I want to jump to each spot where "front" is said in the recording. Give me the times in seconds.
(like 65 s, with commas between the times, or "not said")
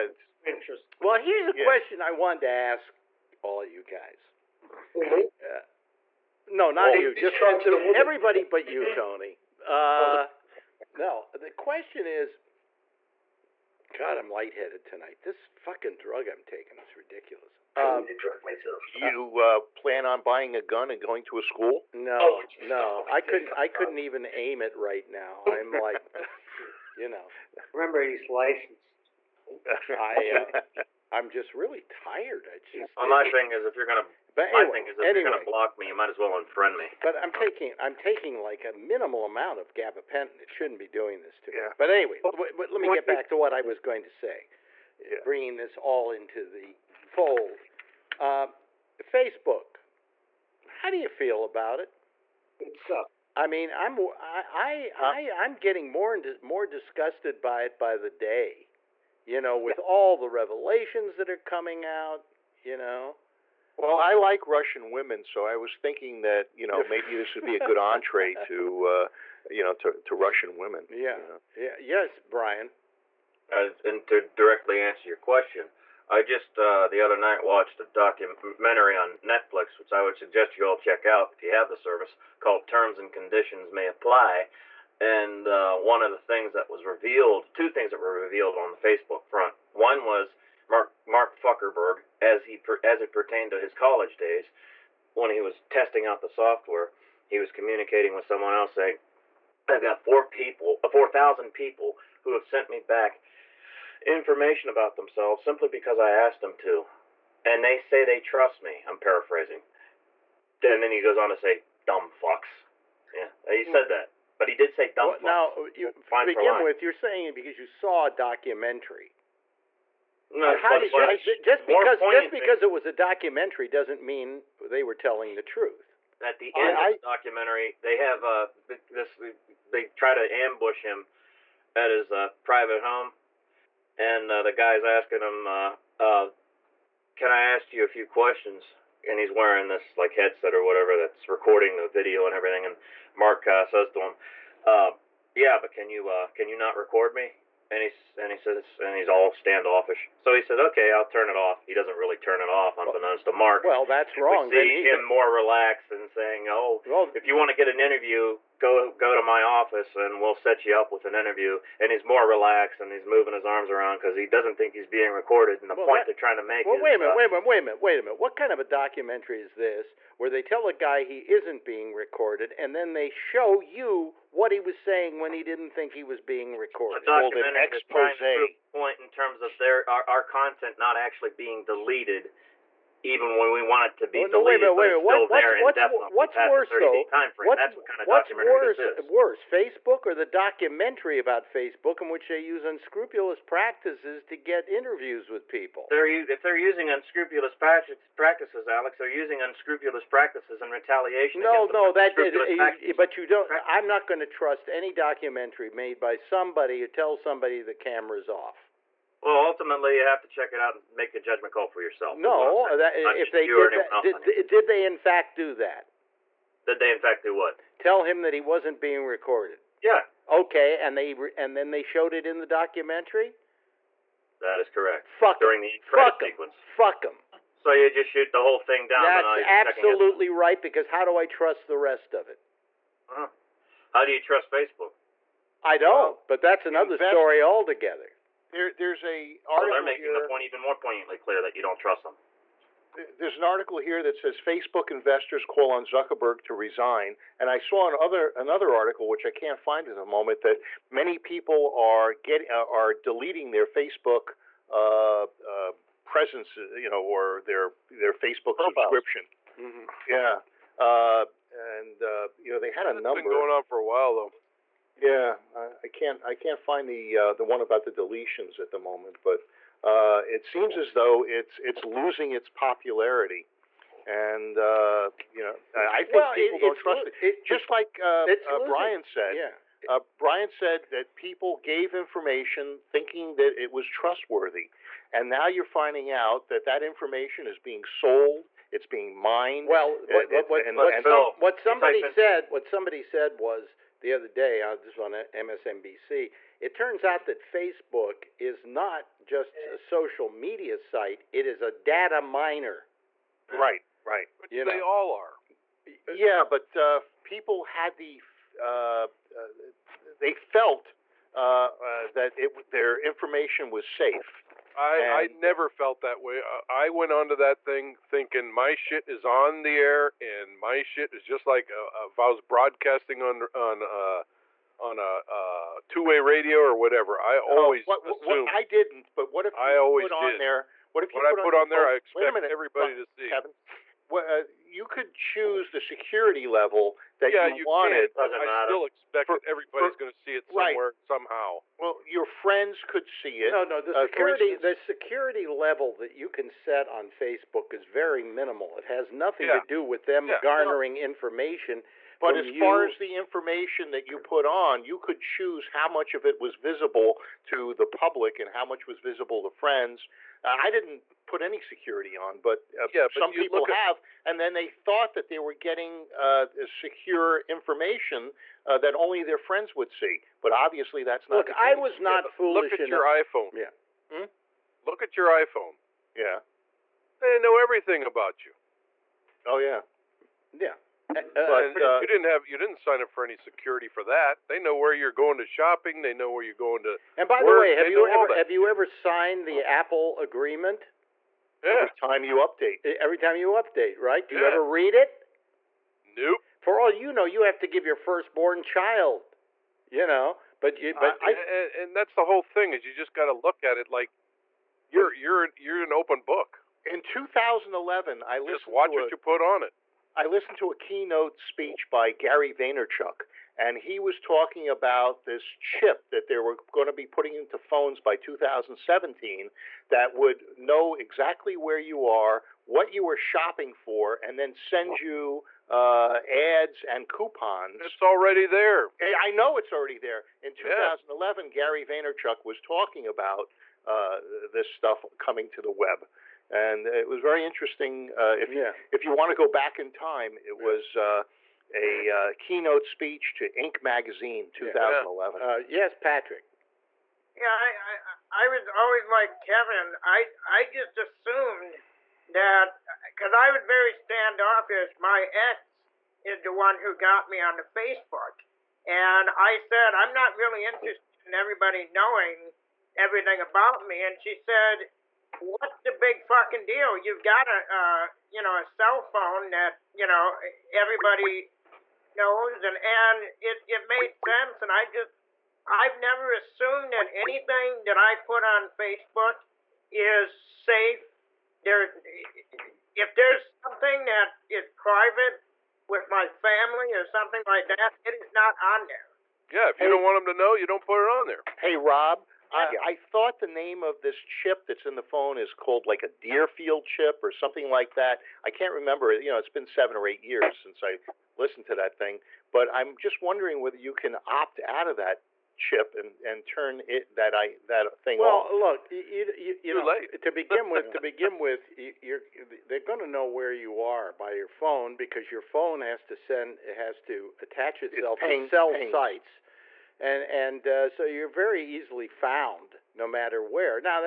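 89 s.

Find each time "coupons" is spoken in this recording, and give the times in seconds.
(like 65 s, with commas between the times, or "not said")
427 s.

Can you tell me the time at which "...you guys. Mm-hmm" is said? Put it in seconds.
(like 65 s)
3 s.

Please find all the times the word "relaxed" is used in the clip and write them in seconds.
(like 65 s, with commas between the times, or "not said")
155 s, 162 s.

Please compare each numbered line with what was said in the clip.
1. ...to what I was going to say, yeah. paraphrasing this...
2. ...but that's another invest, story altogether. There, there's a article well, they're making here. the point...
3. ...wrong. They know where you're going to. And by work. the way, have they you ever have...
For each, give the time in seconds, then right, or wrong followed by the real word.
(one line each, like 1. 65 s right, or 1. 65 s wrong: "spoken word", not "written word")
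1. 43 s wrong: "bringing", not "paraphrasing"
2. 236 s right
3. 385 s wrong: "shopping", not "wrong".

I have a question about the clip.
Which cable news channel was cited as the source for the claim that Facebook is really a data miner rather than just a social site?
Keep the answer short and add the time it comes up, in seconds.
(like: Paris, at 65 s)
MSNBC, at 295 s.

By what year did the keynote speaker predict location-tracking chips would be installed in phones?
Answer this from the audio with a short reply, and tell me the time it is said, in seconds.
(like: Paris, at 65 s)
2017, at 418 s.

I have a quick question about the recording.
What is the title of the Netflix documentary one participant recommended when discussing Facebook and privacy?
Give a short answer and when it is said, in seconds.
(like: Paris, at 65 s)
Terms and Conditions May Apply, at 82 s.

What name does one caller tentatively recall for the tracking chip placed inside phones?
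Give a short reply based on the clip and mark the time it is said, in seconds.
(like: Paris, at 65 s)
Deerfield chip, at 496 s.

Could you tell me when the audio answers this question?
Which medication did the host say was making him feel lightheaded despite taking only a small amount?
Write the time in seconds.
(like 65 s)
39 s.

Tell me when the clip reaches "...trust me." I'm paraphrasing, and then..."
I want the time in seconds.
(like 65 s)
108 s.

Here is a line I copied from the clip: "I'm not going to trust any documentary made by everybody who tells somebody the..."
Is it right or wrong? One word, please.
wrong.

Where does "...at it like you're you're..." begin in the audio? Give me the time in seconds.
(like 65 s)
403 s.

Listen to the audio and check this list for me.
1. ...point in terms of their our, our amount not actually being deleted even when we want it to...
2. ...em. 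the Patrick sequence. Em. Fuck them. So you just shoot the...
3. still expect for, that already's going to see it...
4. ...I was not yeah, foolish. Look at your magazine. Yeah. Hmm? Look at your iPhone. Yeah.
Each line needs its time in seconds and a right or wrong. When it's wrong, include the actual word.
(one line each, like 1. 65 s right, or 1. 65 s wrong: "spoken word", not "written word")
1. 178 s wrong: "content", not "amount"
2. 225 s wrong: "Fuck", not "Patrick"
3. 338 s wrong: "everybody", not "already"
4. 371 s wrong: "iPhone", not "magazine".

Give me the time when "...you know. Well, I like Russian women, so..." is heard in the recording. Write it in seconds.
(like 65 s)
62 s.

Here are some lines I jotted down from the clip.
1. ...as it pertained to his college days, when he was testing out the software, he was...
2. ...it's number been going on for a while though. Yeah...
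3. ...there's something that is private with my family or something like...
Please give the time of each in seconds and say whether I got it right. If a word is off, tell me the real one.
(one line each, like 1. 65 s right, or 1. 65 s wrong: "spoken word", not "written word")
1. 92 s right
2. 262 s right
3. 483 s right.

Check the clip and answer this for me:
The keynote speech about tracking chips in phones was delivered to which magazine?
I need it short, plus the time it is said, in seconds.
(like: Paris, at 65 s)
Inc., at 443 s.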